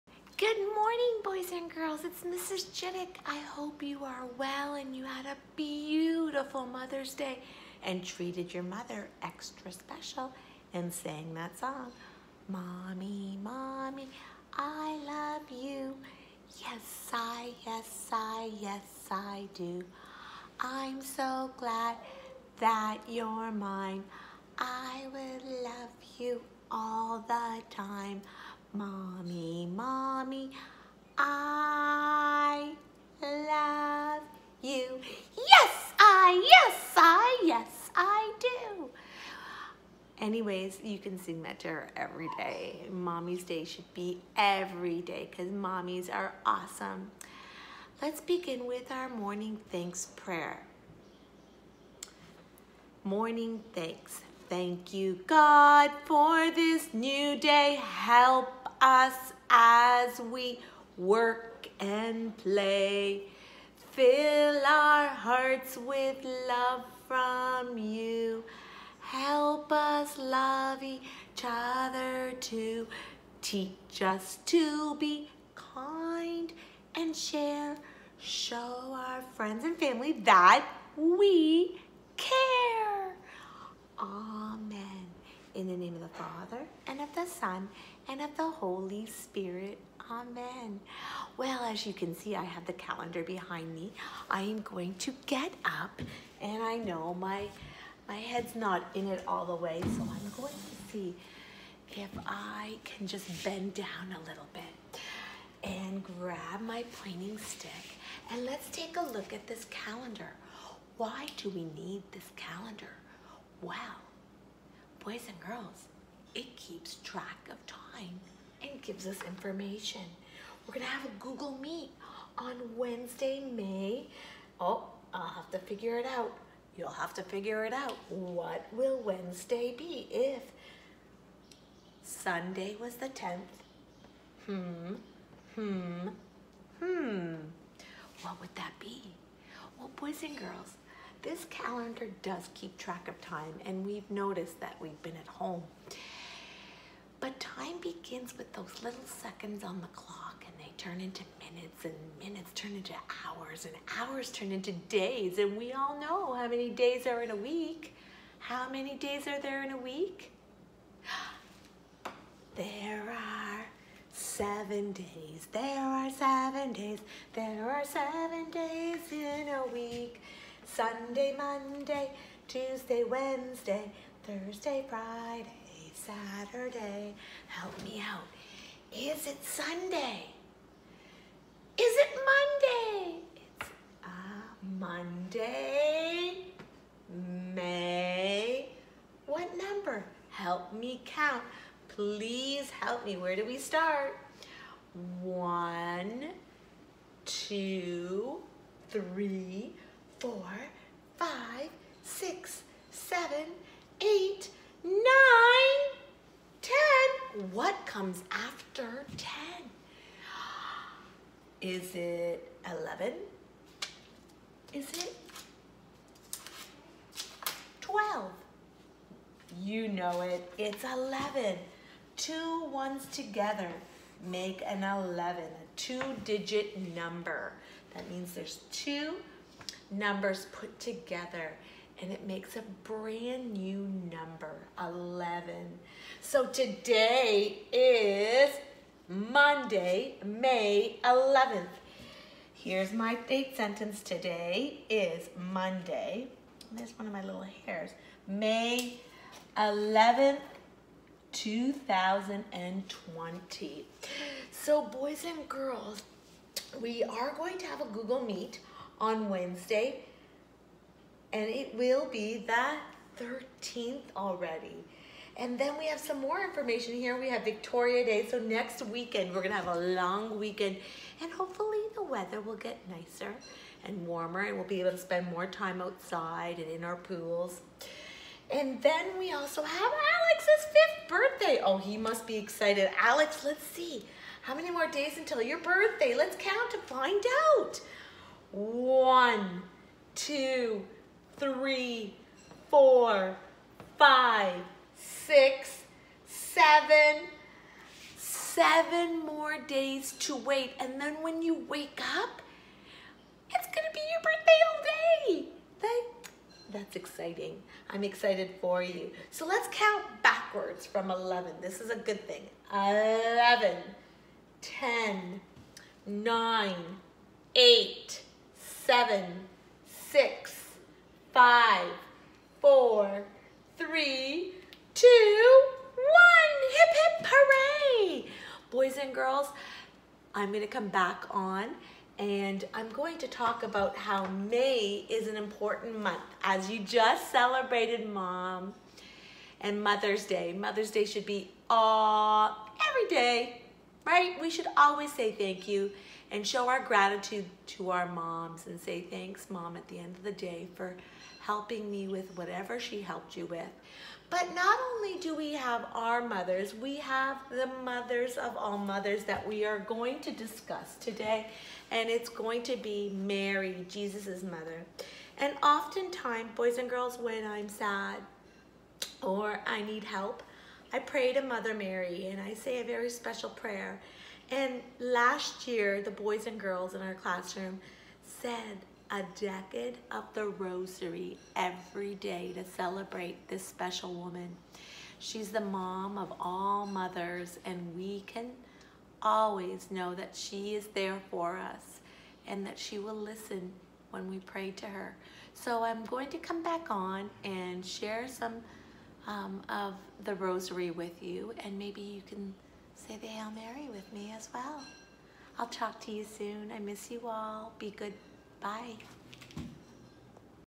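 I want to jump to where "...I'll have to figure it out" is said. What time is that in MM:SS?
02:05.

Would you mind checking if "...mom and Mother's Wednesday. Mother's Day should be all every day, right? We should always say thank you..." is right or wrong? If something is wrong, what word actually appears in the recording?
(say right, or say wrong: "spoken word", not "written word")
wrong: "Day", not "Wednesday".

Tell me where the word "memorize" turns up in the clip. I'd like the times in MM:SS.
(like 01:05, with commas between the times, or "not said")
not said.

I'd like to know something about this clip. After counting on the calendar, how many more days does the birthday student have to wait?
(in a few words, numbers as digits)
7.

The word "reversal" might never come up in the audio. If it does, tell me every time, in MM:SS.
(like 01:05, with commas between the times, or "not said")
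not said.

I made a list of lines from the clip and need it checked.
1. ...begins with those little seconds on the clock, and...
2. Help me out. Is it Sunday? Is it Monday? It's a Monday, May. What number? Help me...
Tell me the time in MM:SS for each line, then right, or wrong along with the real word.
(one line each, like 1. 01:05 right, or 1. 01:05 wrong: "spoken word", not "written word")
1. 02:27 right
2. 02:57 right.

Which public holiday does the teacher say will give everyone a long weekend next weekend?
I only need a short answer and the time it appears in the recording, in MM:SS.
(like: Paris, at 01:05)
Victoria Day, at 04:27.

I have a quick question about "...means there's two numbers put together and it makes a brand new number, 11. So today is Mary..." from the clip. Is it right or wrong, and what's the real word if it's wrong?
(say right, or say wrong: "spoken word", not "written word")
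wrong: "Monday", not "Mary".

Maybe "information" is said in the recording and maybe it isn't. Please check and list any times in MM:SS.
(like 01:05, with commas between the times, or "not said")
01:59, 04:26.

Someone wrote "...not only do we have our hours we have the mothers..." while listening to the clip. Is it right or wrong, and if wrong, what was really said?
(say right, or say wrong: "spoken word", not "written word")
wrong: "mothers", not "hours".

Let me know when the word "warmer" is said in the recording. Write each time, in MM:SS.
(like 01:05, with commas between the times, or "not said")
04:34.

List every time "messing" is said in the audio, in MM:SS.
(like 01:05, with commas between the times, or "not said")
not said.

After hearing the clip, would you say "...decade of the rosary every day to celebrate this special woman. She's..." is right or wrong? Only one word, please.
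right.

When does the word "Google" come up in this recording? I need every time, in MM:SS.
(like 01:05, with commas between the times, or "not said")
02:01, 04:17.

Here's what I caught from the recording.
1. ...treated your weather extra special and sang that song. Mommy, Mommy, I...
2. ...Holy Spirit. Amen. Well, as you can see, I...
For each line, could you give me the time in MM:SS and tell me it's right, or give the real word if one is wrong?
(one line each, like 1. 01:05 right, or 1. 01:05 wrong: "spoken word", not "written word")
1. 00:08 wrong: "mother", not "weather"
2. 01:28 right.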